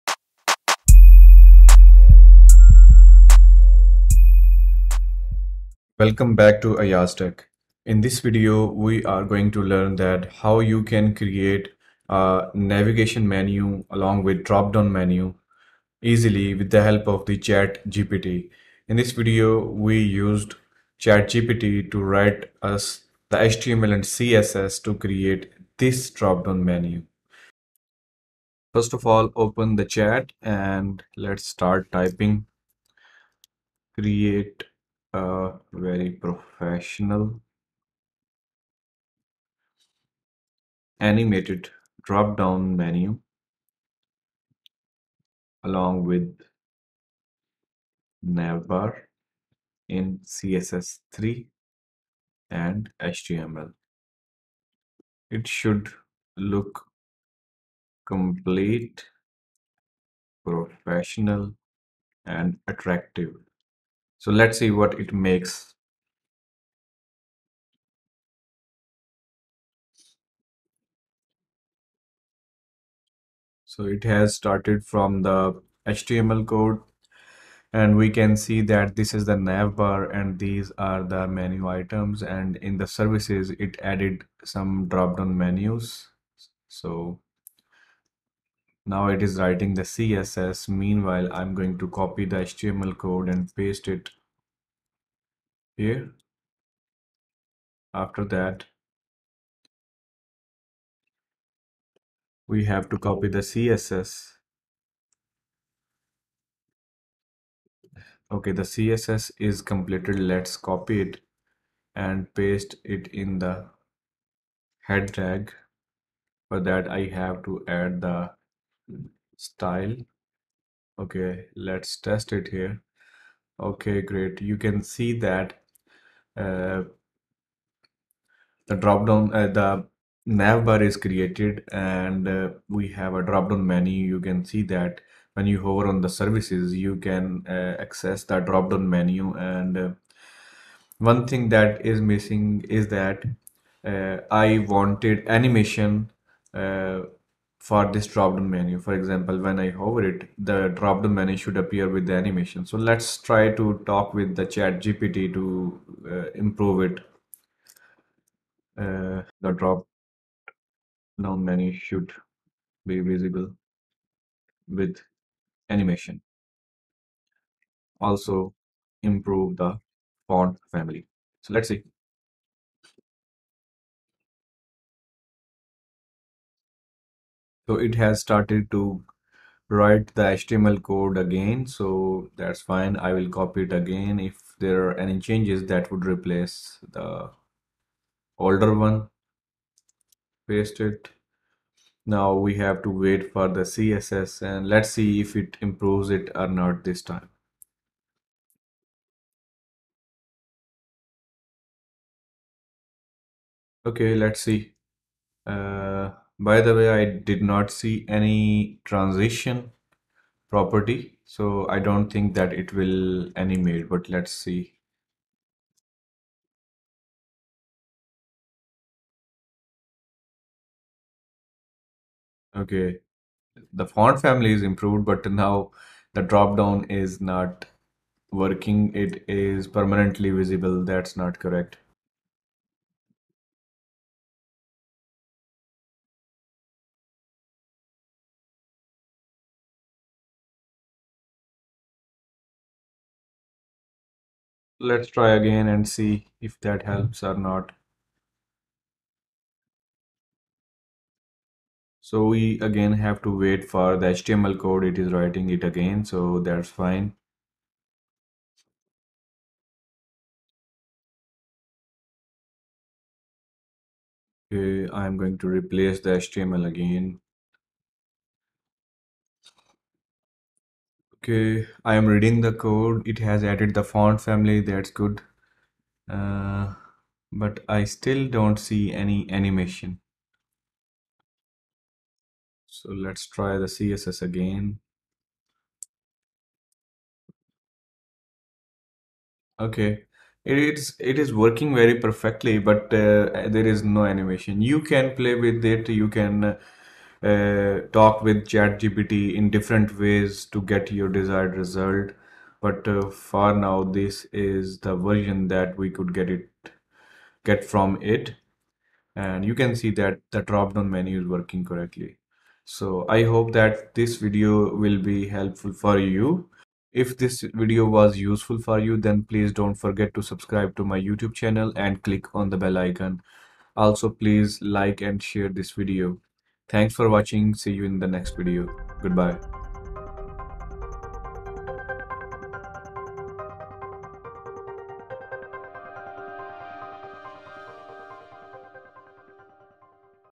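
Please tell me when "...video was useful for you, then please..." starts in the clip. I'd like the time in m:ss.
5:17.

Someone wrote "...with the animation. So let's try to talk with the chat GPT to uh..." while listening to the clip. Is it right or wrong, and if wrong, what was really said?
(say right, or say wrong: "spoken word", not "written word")
right.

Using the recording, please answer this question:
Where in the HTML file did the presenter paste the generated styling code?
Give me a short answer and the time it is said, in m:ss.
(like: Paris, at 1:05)
head tag, at 1:54.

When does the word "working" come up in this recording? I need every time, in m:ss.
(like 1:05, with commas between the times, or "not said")
3:48, 4:51, 5:11.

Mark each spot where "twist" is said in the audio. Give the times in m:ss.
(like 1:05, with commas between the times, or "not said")
not said.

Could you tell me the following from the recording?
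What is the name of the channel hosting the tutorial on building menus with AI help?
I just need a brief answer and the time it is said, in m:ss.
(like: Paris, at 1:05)
AyyazTech, at 0:06.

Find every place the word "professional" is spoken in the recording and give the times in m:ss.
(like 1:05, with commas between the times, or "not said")
0:36, 1:00.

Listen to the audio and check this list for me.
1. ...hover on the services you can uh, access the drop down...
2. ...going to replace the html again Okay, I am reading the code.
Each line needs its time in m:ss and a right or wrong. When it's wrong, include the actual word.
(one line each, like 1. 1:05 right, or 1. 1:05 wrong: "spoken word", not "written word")
1. 2:15 right
2. 4:25 right.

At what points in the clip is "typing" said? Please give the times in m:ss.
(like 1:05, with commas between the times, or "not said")
0:31.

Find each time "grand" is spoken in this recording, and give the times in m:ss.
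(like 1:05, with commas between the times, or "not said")
not said.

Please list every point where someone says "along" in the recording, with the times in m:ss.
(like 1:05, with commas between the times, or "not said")
0:13, 0:45.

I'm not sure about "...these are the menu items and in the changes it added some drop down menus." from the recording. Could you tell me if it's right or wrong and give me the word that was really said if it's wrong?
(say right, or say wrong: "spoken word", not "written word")
wrong: "services", not "changes".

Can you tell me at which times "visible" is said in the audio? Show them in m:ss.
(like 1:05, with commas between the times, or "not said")
2:43, 3:50.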